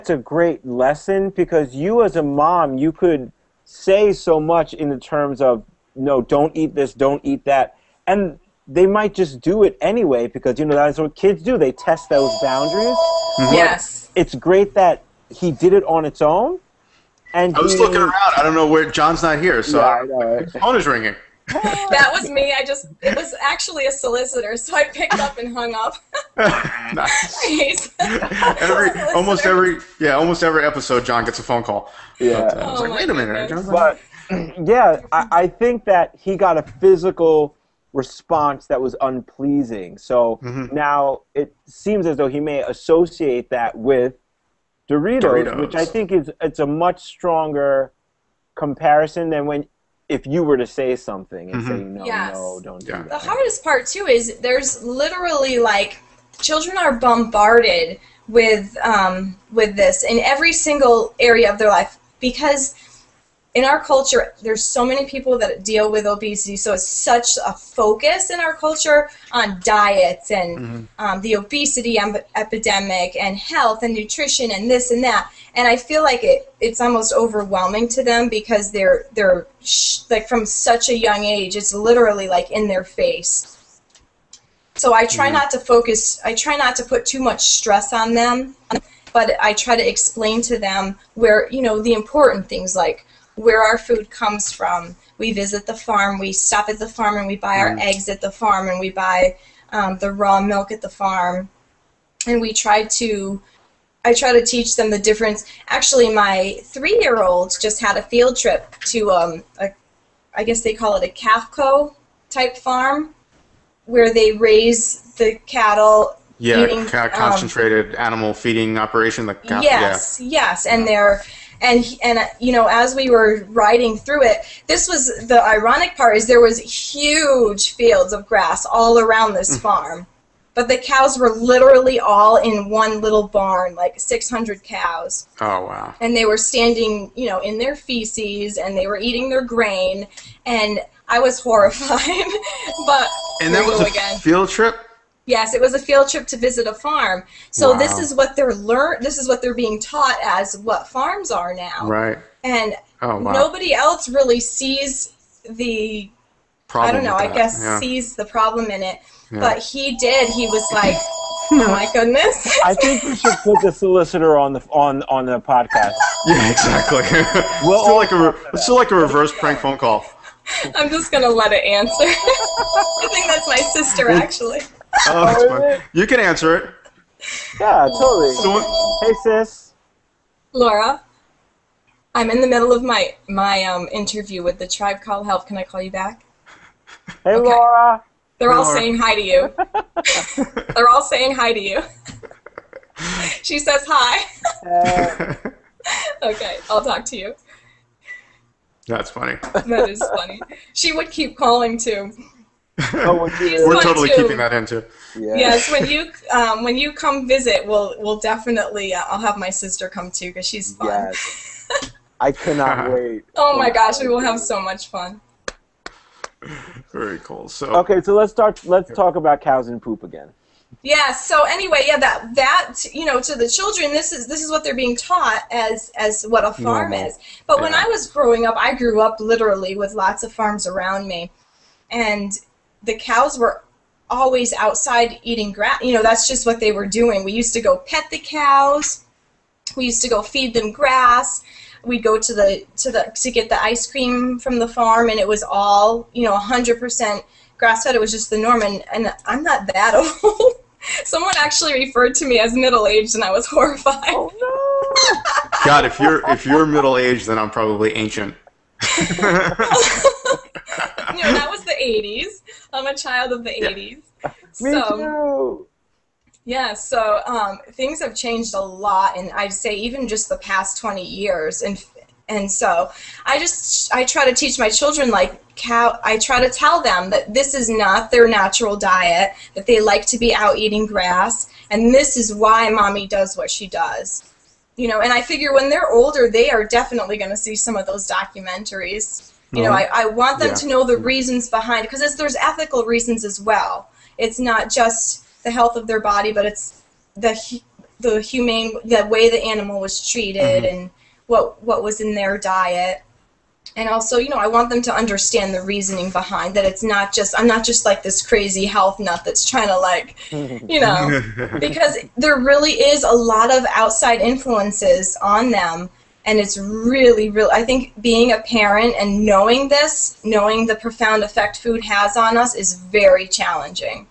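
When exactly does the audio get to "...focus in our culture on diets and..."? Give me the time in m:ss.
1:07.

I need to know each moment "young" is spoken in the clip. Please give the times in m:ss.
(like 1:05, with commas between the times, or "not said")
1:20.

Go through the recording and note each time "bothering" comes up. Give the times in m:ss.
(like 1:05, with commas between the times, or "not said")
not said.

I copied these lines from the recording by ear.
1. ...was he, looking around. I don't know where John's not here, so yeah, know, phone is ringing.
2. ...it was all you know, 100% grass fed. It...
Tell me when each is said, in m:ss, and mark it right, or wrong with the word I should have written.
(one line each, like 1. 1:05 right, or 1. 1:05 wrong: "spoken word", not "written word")
1. 0:17 right
2. 4:05 right.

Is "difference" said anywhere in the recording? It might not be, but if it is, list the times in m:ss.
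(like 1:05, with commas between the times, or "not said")
1:44.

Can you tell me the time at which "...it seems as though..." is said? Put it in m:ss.
0:41.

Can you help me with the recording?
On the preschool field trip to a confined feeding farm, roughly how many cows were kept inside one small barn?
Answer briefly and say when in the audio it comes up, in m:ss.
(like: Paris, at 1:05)
600, at 2:13.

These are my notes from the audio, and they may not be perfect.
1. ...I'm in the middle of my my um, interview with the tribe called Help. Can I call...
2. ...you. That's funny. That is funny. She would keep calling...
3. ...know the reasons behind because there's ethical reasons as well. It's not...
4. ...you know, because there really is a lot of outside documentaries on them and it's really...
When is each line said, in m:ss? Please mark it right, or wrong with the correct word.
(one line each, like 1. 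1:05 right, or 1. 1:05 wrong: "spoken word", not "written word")
1. 3:02 right
2. 3:17 right
3. 4:50 right
4. 5:10 wrong: "influences", not "documentaries".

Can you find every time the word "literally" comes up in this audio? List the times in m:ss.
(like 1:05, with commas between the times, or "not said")
0:54, 1:21, 2:11, 3:49.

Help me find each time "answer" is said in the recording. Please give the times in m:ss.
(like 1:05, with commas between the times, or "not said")
2:51, 2:56.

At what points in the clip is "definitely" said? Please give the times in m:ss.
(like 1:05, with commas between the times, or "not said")
3:28, 4:46.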